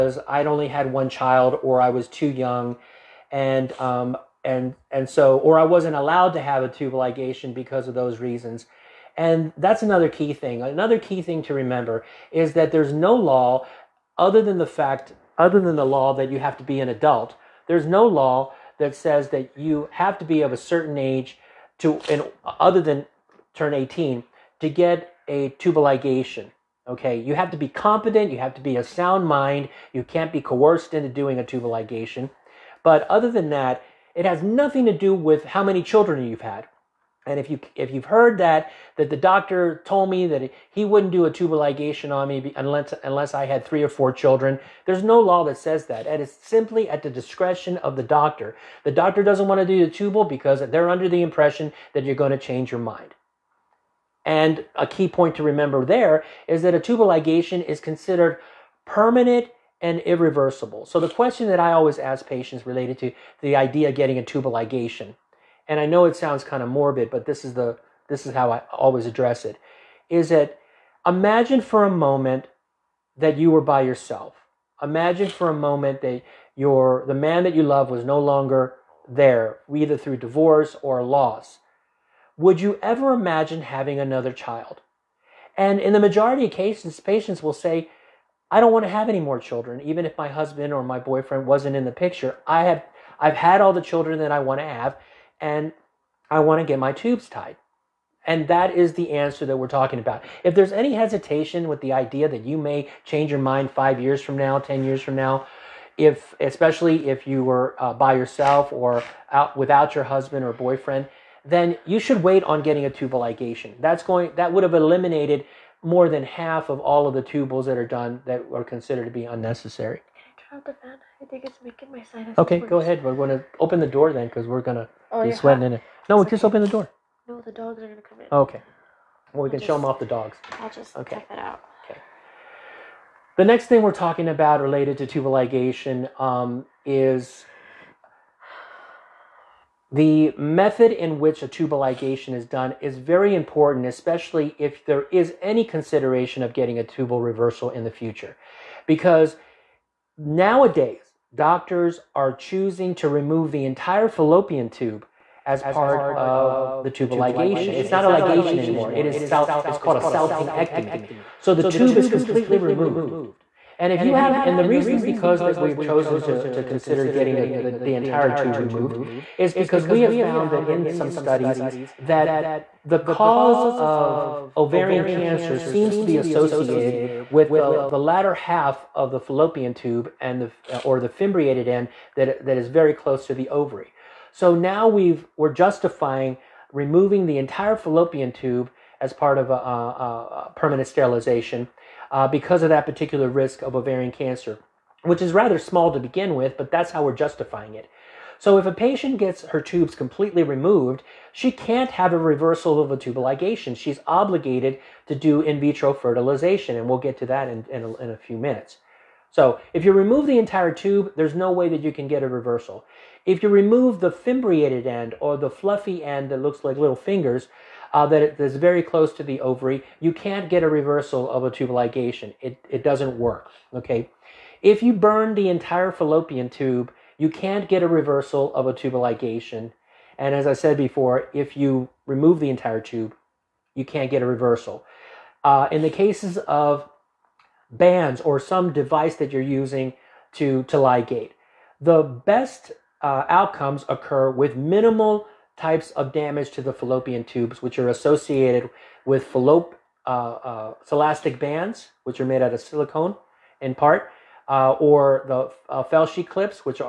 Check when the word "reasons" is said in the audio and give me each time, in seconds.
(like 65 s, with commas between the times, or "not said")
8 s, 164 s.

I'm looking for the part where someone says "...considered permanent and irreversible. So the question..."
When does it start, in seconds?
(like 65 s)
57 s.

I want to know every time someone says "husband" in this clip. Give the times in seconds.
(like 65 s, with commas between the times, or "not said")
90 s, 110 s.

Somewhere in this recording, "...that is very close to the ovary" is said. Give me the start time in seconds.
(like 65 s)
182 s.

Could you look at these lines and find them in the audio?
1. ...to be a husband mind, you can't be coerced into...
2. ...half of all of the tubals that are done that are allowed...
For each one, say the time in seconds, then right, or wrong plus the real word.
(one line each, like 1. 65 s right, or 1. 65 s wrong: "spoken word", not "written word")
1. 28 s wrong: "sound", not "husband"
2. 116 s wrong: "considered", not "allowed".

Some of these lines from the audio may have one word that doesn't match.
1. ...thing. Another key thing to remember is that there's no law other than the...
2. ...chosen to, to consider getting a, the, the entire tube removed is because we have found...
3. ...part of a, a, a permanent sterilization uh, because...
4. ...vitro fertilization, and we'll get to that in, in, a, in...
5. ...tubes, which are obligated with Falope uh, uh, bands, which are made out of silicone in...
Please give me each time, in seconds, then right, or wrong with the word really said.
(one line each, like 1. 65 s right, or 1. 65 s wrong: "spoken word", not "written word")
1. 10 s right
2. 165 s right
3. 189 s right
4. 205 s right
5. 247 s wrong: "associated", not "obligated".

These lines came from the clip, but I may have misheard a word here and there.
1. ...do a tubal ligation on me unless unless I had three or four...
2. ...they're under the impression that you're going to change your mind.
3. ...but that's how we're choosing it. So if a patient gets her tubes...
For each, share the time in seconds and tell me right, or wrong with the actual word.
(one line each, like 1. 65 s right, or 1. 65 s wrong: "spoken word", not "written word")
1. 41 s right
2. 50 s right
3. 196 s wrong: "justifying", not "choosing".